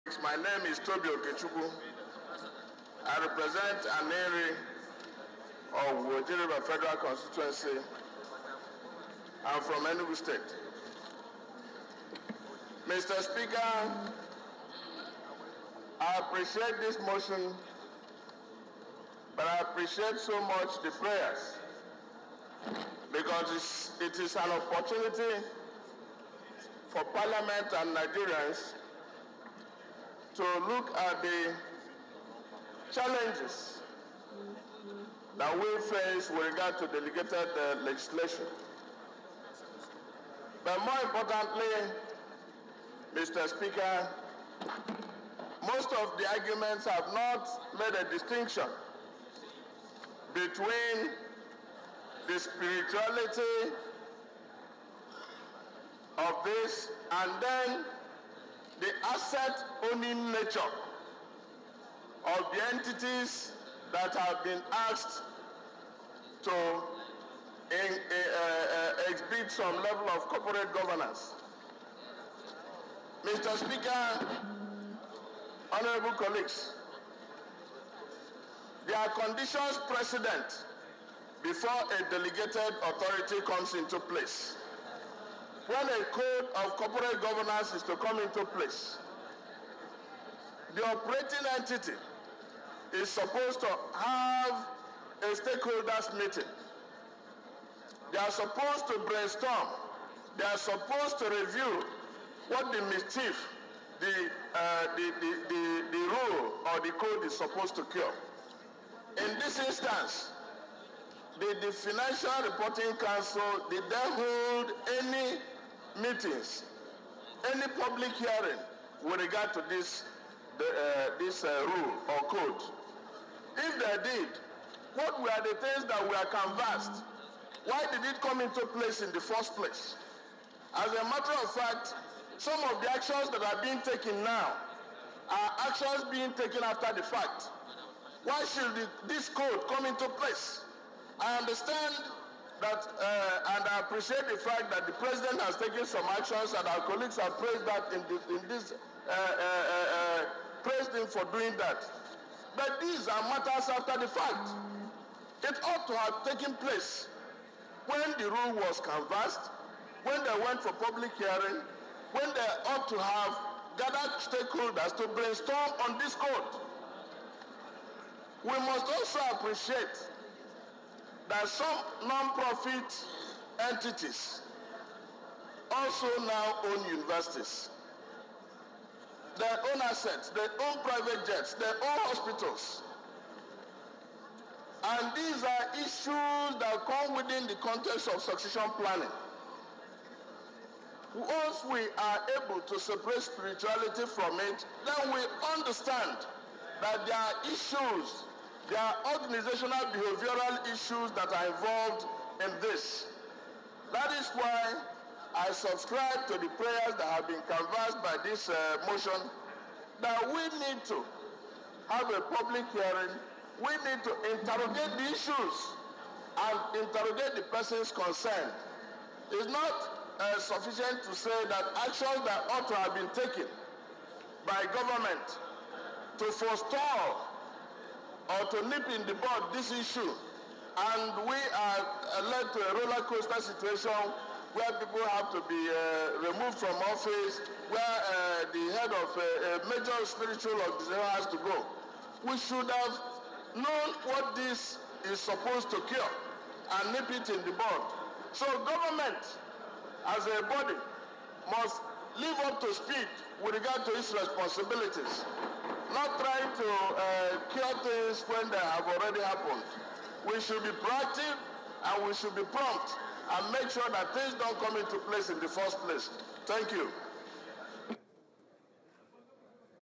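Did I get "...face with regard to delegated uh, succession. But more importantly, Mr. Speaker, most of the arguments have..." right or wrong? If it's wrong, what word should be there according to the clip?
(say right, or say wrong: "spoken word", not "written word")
wrong: "legislation", not "succession".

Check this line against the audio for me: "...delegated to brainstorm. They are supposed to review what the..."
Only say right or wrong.
wrong.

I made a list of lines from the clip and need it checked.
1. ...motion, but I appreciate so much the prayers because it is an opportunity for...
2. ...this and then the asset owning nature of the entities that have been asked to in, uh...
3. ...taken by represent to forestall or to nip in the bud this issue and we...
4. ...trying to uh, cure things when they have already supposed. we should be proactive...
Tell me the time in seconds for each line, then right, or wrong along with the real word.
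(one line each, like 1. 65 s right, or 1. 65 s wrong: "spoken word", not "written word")
1. 17 s right
2. 56 s right
3. 223 s wrong: "government", not "represent"
4. 256 s wrong: "happened", not "supposed".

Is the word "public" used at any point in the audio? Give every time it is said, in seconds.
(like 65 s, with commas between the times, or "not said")
117 s, 160 s, 212 s.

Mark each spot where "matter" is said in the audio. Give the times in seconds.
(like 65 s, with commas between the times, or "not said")
131 s, 153 s.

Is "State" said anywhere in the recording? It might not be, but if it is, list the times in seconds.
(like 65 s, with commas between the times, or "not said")
10 s.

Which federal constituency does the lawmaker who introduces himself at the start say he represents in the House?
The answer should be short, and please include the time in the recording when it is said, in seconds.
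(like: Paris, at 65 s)
Aninri Awgu Oji River, at 4 s.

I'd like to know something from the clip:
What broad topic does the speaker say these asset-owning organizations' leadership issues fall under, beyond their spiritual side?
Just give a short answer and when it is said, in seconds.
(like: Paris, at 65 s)
succession planning, at 188 s.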